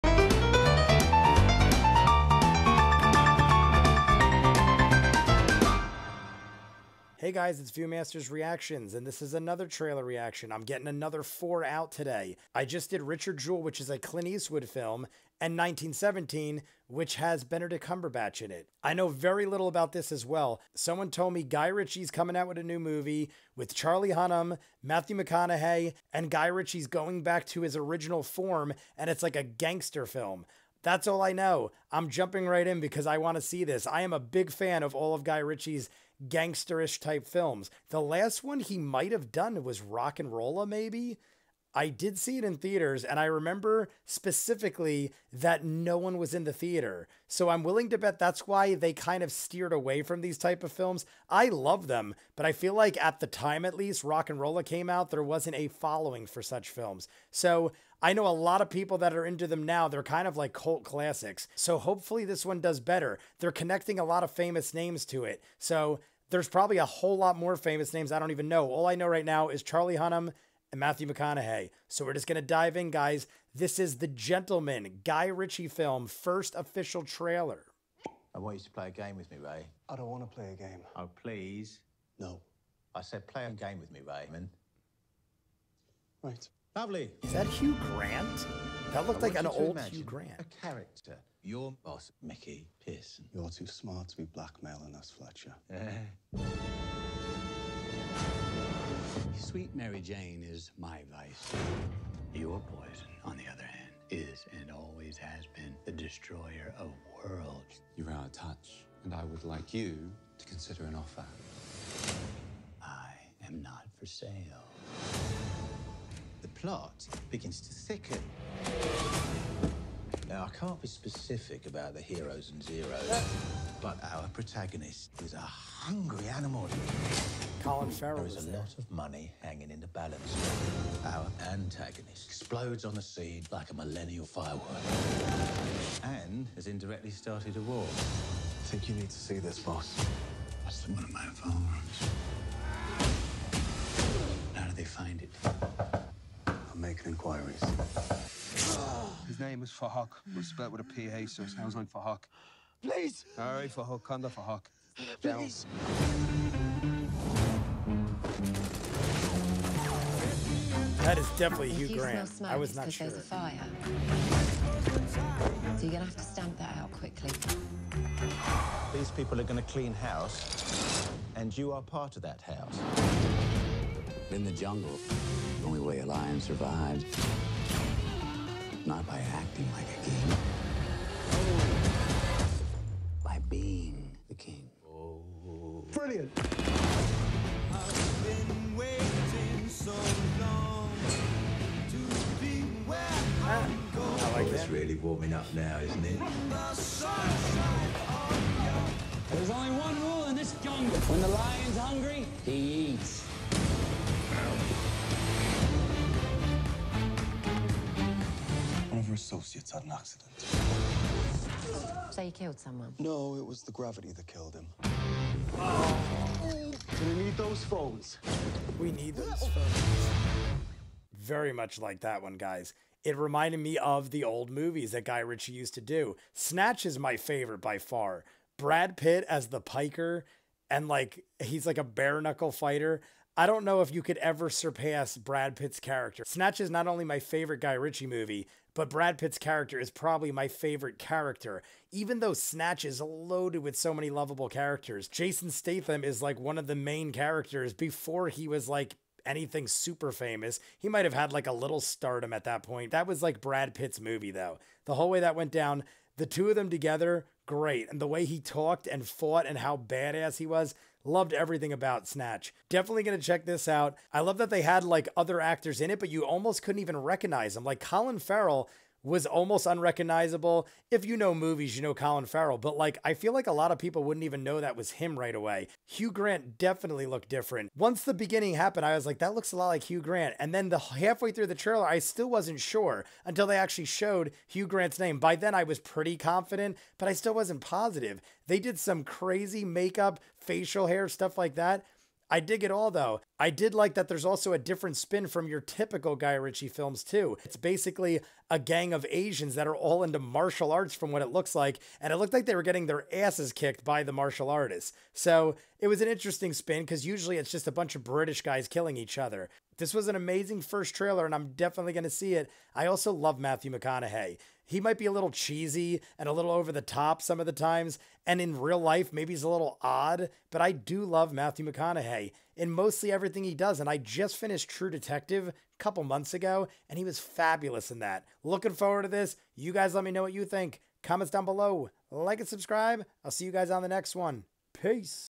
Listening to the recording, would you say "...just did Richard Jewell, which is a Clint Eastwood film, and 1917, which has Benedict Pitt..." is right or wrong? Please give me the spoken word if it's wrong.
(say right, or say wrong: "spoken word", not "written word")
wrong: "Cumberbatch", not "Pitt".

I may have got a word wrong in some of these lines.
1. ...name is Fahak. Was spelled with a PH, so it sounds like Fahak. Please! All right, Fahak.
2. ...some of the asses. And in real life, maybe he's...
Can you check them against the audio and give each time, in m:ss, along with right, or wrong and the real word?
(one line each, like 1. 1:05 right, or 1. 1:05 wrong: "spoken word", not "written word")
1. 2:29 right
2. 5:17 wrong: "times", not "asses".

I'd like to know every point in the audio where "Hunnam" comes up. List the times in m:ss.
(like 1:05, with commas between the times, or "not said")
0:24, 1:09.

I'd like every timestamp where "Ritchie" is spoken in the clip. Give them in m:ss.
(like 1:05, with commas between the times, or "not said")
0:21, 0:26, 0:35, 1:15, 3:45, 3:57, 4:56.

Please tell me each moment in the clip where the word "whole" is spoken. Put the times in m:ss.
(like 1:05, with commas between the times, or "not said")
1:06, 4:14.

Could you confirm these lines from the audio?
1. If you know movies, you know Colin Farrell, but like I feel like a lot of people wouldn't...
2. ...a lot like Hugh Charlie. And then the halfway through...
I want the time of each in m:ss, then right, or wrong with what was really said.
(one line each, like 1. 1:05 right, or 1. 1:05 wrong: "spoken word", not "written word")
1. 4:30 right
2. 4:39 wrong: "Grant", not "Charlie".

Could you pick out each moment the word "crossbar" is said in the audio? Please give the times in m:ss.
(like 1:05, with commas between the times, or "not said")
not said.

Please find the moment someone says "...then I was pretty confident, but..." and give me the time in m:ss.
4:45.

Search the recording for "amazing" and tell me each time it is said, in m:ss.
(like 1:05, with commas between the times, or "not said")
5:10.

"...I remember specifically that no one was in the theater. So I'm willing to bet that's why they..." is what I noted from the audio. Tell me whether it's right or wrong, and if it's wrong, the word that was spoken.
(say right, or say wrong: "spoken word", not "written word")
right.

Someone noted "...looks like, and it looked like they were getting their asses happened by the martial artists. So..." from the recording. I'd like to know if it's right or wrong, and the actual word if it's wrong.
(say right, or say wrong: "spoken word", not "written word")
wrong: "kicked", not "happened".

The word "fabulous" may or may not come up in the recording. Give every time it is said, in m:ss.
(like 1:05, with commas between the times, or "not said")
5:27.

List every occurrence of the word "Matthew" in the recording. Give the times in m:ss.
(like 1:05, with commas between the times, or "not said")
0:24, 1:10, 5:13, 5:21.